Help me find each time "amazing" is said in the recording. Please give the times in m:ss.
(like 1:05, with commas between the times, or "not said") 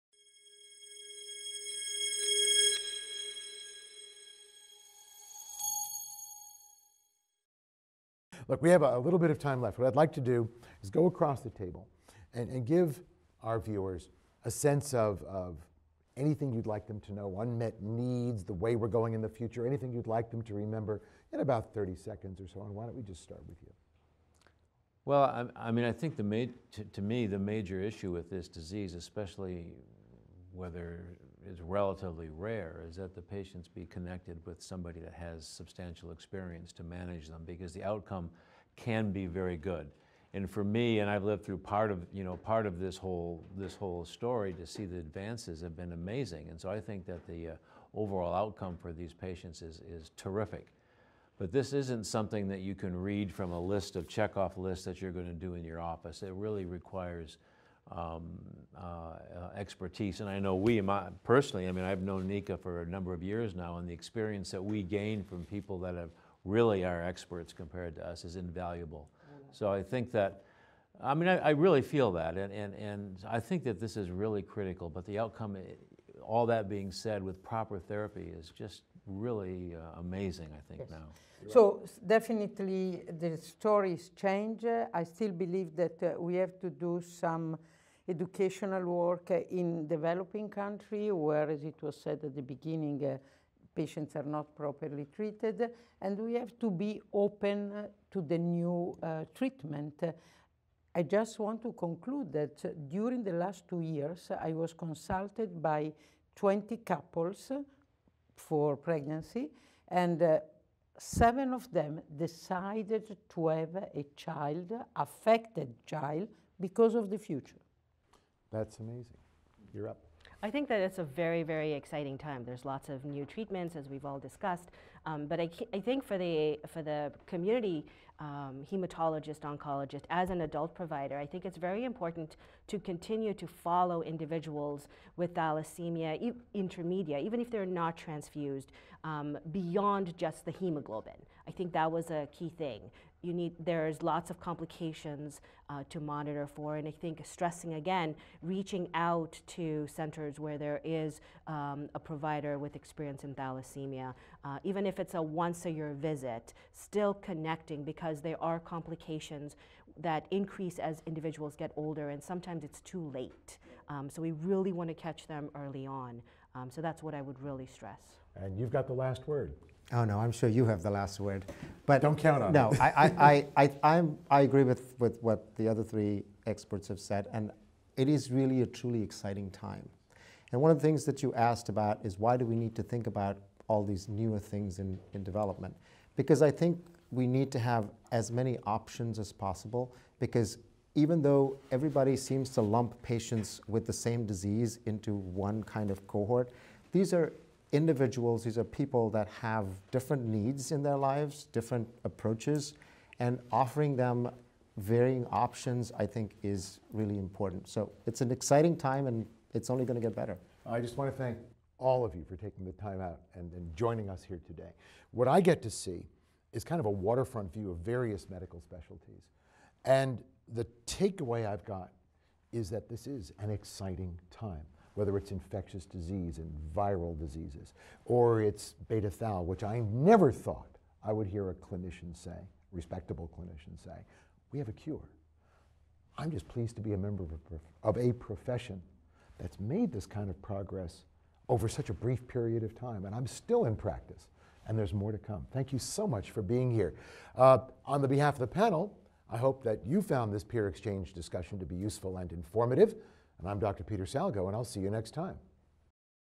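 0:45, 1:19, 1:58.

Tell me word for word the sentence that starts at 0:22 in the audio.
And why don't we just start with you?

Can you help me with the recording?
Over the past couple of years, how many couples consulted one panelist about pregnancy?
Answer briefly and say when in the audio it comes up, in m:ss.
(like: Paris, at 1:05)
20, at 1:46.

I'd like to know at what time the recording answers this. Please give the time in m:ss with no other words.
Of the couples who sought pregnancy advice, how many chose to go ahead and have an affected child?
1:50.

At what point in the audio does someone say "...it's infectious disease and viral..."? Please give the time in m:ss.
3:45.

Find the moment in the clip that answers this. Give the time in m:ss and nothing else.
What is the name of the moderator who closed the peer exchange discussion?
4:13.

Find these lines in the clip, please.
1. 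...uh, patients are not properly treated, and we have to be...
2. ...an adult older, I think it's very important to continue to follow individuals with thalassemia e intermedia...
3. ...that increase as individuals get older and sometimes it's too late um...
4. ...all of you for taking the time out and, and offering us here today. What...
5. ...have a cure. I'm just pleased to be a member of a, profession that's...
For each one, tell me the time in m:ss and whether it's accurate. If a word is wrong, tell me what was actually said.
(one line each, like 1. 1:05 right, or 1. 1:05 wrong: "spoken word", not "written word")
1. 1:33 right
2. 2:10 wrong: "provider", not "older"
3. 2:39 right
4. 3:31 wrong: "joining", not "offering"
5. 3:54 right.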